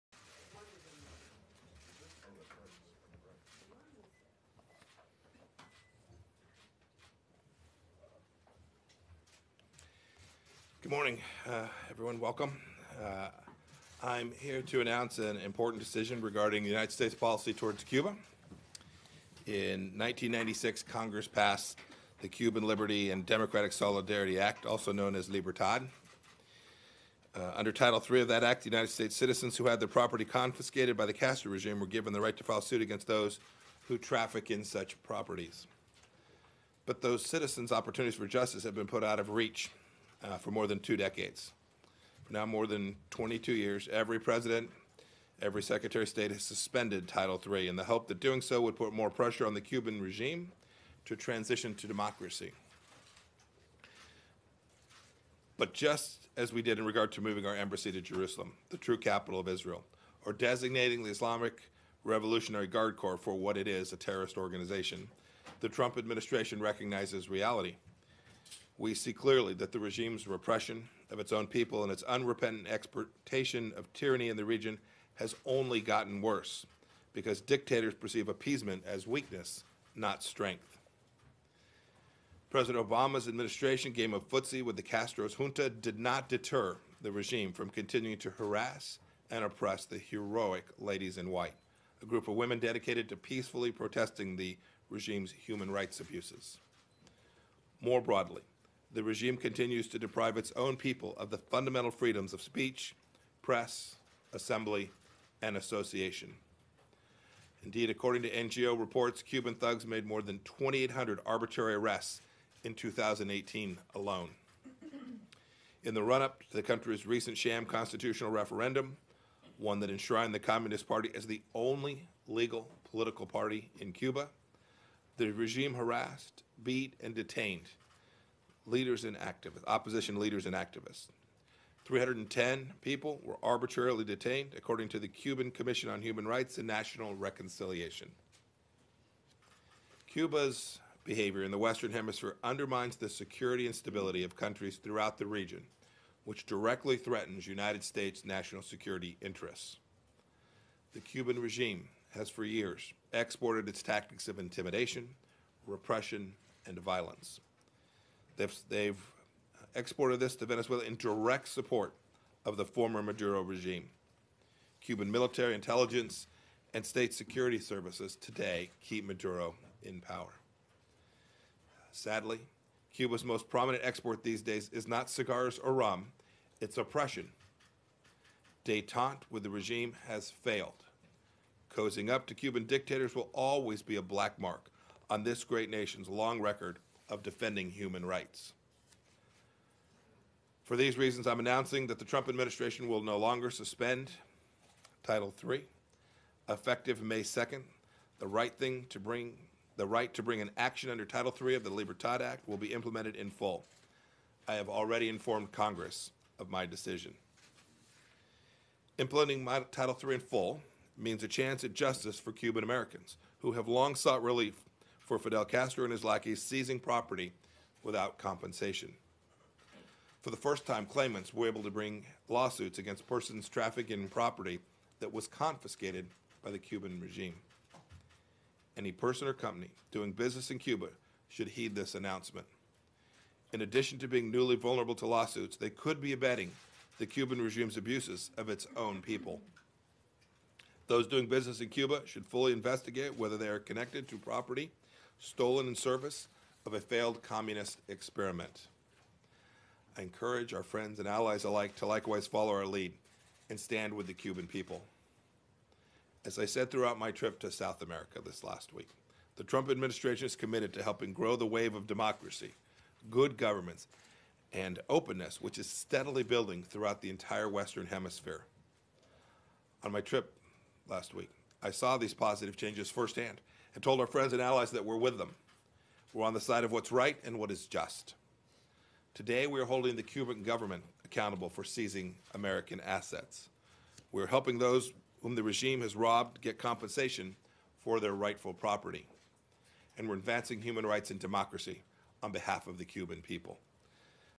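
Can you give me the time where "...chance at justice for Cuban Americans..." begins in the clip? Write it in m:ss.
3:31.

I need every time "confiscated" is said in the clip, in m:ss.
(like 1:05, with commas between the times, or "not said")
0:30, 3:45.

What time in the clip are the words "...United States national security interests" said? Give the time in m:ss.
2:27.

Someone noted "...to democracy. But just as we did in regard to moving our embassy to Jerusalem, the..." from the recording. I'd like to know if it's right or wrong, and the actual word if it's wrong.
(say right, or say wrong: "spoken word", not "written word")
right.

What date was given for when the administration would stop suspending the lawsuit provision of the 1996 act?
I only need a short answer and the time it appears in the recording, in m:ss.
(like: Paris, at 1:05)
May 2nd, at 3:17.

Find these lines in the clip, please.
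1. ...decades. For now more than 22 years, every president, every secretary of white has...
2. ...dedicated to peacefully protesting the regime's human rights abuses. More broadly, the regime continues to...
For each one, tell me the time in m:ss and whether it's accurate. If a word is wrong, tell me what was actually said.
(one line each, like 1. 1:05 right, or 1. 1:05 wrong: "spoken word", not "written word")
1. 0:40 wrong: "state", not "white"
2. 1:32 right.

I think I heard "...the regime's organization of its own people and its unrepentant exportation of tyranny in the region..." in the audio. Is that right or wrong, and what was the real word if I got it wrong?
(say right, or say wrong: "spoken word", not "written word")
wrong: "repression", not "organization".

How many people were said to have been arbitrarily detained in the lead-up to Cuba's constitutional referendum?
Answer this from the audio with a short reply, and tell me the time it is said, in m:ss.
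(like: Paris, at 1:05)
310, at 2:11.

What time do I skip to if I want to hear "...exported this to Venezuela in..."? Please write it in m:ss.
2:39.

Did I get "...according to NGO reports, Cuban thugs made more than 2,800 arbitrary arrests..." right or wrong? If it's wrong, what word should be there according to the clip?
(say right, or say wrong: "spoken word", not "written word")
right.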